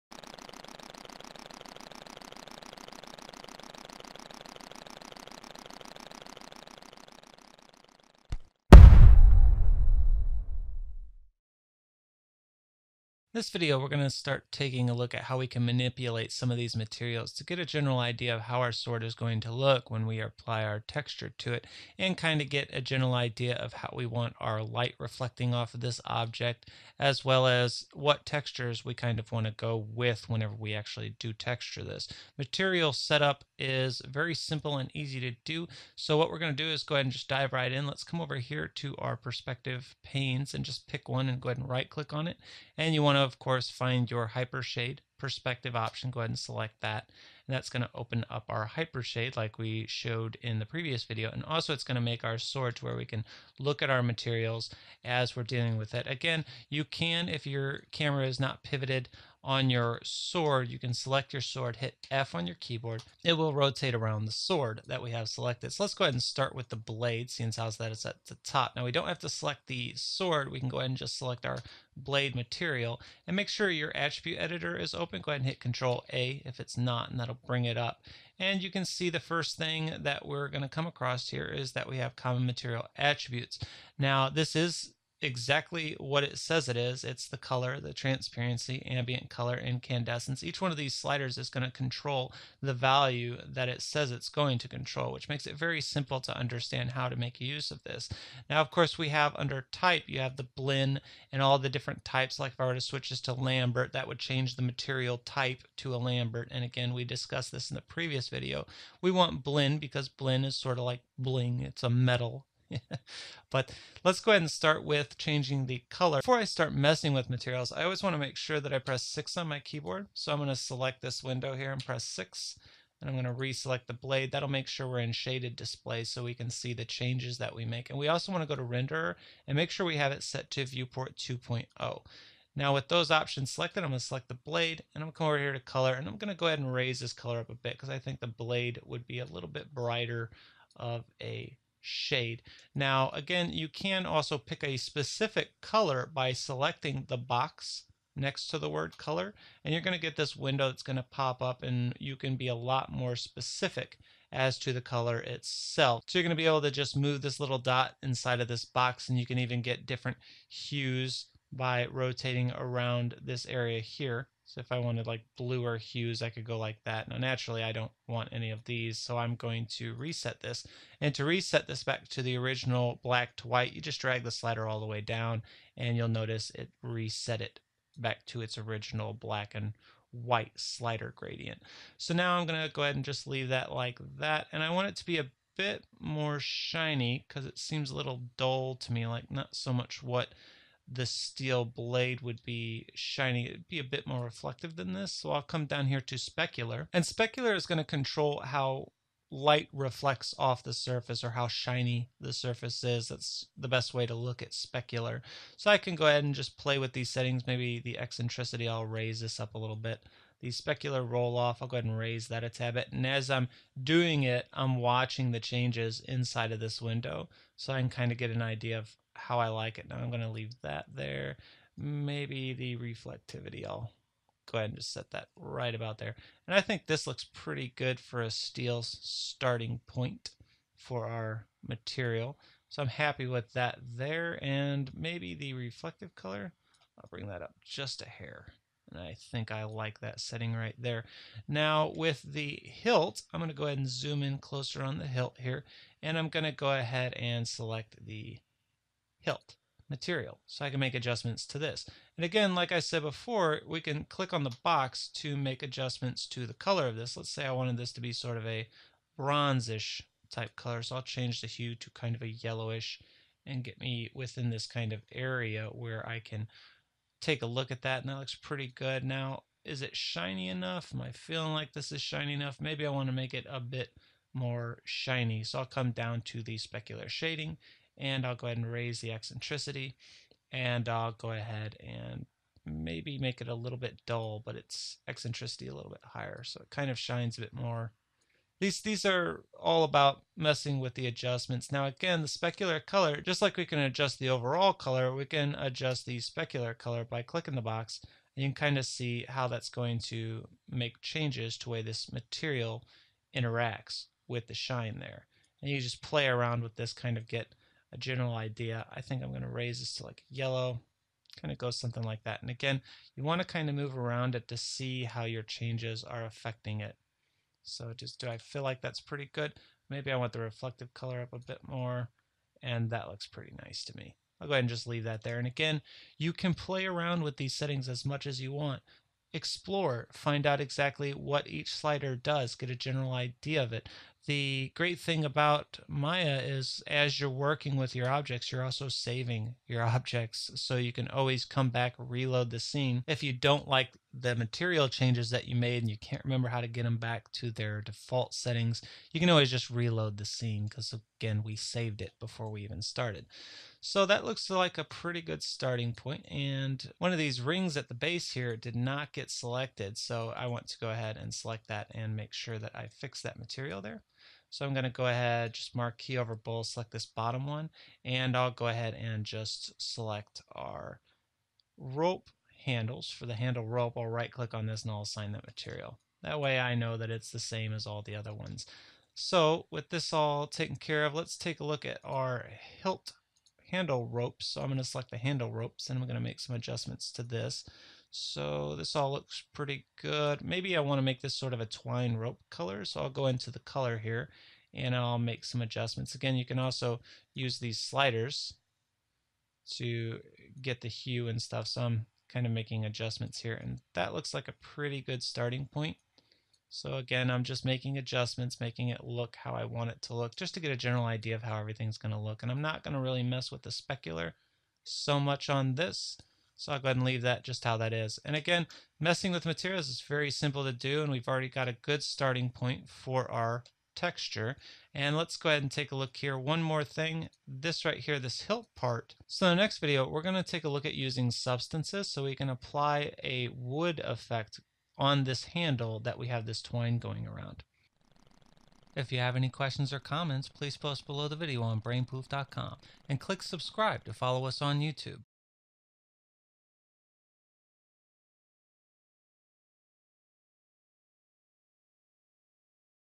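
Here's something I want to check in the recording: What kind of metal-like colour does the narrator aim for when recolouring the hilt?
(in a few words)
Bronzish.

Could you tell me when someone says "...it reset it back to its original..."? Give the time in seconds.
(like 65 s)
176 s.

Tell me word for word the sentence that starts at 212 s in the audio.
And as I'm doing it, I'm watching the changes inside of this window.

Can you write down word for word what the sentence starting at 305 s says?
And you just play around with this, kind of get a general idea.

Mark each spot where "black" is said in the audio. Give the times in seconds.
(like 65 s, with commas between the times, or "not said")
173 s, 179 s.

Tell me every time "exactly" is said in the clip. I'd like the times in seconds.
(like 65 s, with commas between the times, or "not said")
85 s, 330 s.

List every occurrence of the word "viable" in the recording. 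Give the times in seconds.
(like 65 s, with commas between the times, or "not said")
not said.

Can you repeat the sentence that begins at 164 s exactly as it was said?
So if I wanted like bluer hues, I could go like that.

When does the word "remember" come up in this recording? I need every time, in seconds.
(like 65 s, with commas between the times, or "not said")
346 s.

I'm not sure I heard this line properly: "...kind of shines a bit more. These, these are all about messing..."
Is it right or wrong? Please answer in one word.
right.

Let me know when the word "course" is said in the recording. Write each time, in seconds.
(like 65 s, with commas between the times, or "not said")
43 s, 98 s.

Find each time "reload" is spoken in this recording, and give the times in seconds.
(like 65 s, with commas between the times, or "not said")
341 s, 349 s.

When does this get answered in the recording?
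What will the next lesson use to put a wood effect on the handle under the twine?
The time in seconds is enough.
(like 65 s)
431 s.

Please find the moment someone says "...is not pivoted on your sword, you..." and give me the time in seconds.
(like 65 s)
58 s.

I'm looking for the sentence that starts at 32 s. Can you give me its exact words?
Material setup is very simple and easy to do.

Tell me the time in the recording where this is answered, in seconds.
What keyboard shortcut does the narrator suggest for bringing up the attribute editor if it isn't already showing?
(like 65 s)
75 s.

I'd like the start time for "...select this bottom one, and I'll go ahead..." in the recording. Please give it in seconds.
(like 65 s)
366 s.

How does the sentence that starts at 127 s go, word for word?
And we also want to go to renderer and make sure we have it set to viewport 2.0.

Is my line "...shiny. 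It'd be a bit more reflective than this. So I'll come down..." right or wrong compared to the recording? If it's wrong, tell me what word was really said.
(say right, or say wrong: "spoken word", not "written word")
right.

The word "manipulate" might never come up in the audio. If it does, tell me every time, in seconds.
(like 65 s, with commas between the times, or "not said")
15 s.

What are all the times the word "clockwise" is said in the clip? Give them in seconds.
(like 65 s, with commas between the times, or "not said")
not said.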